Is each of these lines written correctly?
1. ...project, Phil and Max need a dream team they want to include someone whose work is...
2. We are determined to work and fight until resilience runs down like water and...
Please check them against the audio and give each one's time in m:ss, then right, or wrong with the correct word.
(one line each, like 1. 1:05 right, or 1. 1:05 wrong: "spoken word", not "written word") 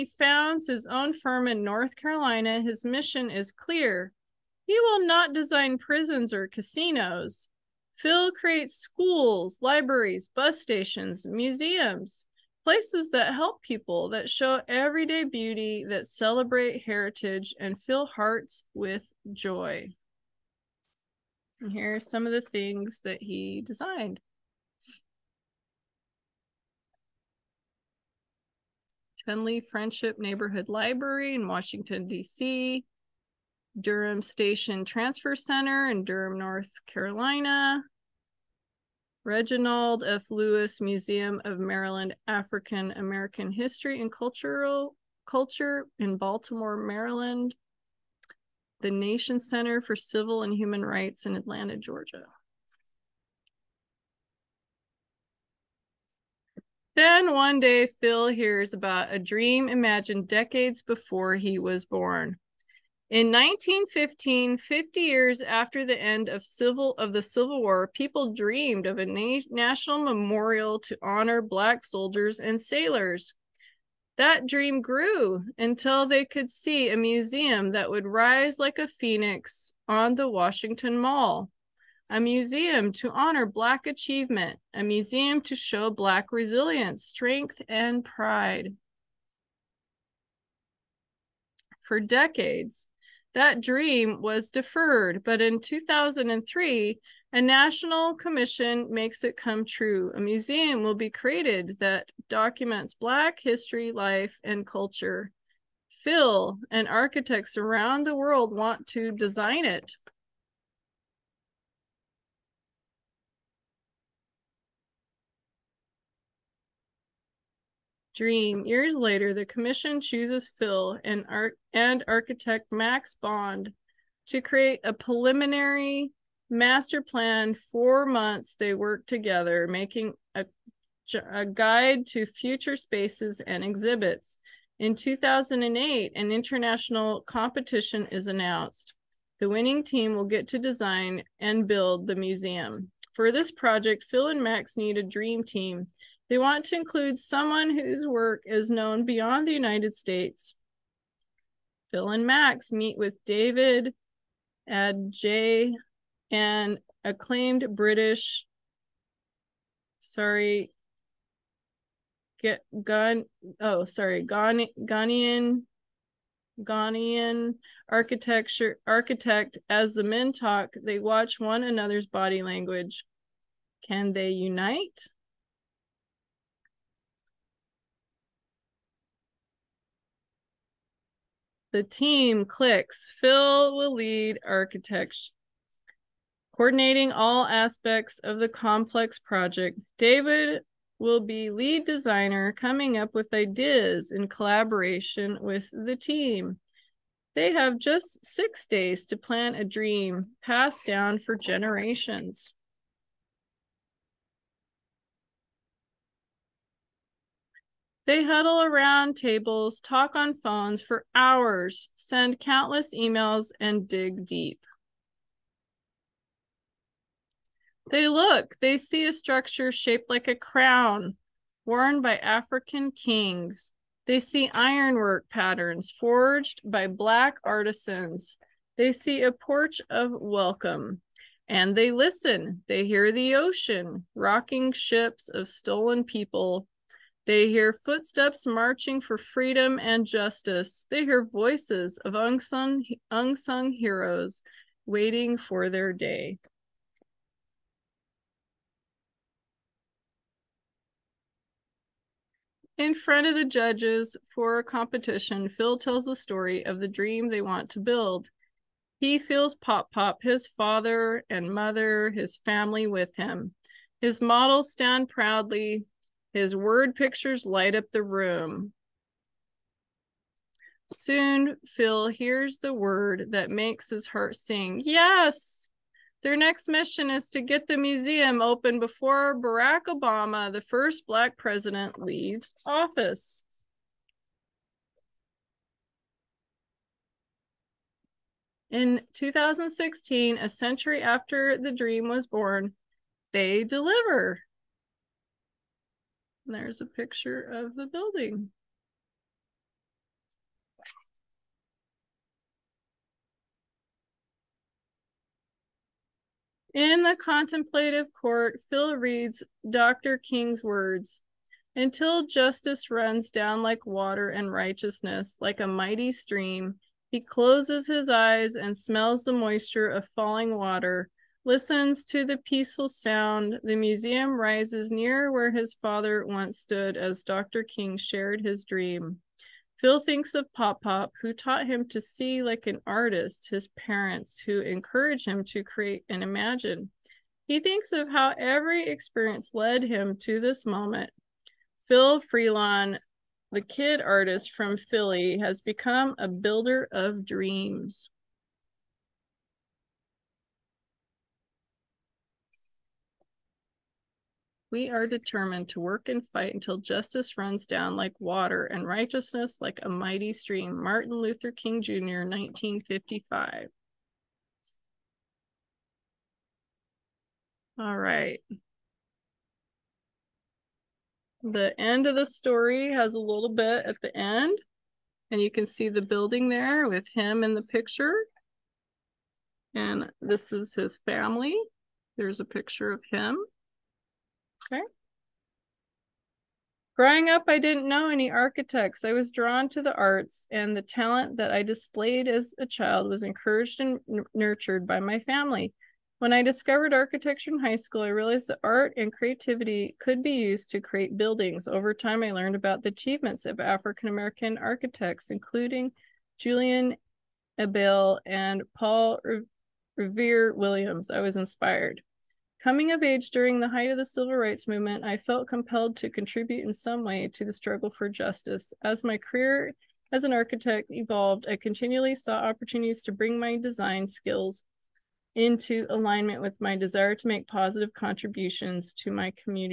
1. 2:23 right
2. 5:54 wrong: "justice", not "resilience".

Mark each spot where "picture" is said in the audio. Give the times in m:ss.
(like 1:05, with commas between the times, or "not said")
4:26, 4:56, 6:17, 6:22.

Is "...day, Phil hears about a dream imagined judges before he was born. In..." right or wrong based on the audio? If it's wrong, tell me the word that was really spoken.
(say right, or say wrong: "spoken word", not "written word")
wrong: "decades", not "judges".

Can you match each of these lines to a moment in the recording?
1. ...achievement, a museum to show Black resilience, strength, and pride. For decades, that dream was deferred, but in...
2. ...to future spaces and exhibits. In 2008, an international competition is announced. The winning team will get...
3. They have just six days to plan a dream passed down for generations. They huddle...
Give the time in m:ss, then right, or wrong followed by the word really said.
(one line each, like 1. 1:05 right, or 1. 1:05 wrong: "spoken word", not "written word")
1. 1:23 right
2. 2:12 right
3. 3:17 right.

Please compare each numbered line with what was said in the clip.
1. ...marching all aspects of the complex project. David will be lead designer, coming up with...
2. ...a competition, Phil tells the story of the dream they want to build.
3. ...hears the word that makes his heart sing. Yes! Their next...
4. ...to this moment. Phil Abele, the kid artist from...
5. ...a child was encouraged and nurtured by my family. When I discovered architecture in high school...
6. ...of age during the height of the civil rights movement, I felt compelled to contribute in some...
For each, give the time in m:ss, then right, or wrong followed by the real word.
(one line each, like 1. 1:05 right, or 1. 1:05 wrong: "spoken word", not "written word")
1. 3:06 wrong: "coordinating", not "marching"
2. 4:14 right
3. 4:32 right
4. 5:40 wrong: "Freelon", not "Abele"
5. 6:32 right
6. 6:52 right.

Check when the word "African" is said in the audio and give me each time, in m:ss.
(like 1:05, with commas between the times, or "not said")
0:42, 3:42, 6:43.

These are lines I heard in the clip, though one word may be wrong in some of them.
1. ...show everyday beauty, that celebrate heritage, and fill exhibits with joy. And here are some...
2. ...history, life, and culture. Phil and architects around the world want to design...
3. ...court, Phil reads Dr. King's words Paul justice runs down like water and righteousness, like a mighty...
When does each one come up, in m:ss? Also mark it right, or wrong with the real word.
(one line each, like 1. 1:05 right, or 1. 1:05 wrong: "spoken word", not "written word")
1. 0:14 wrong: "hearts", not "exhibits"
2. 1:43 right
3. 5:08 wrong: "Until", not "Paul".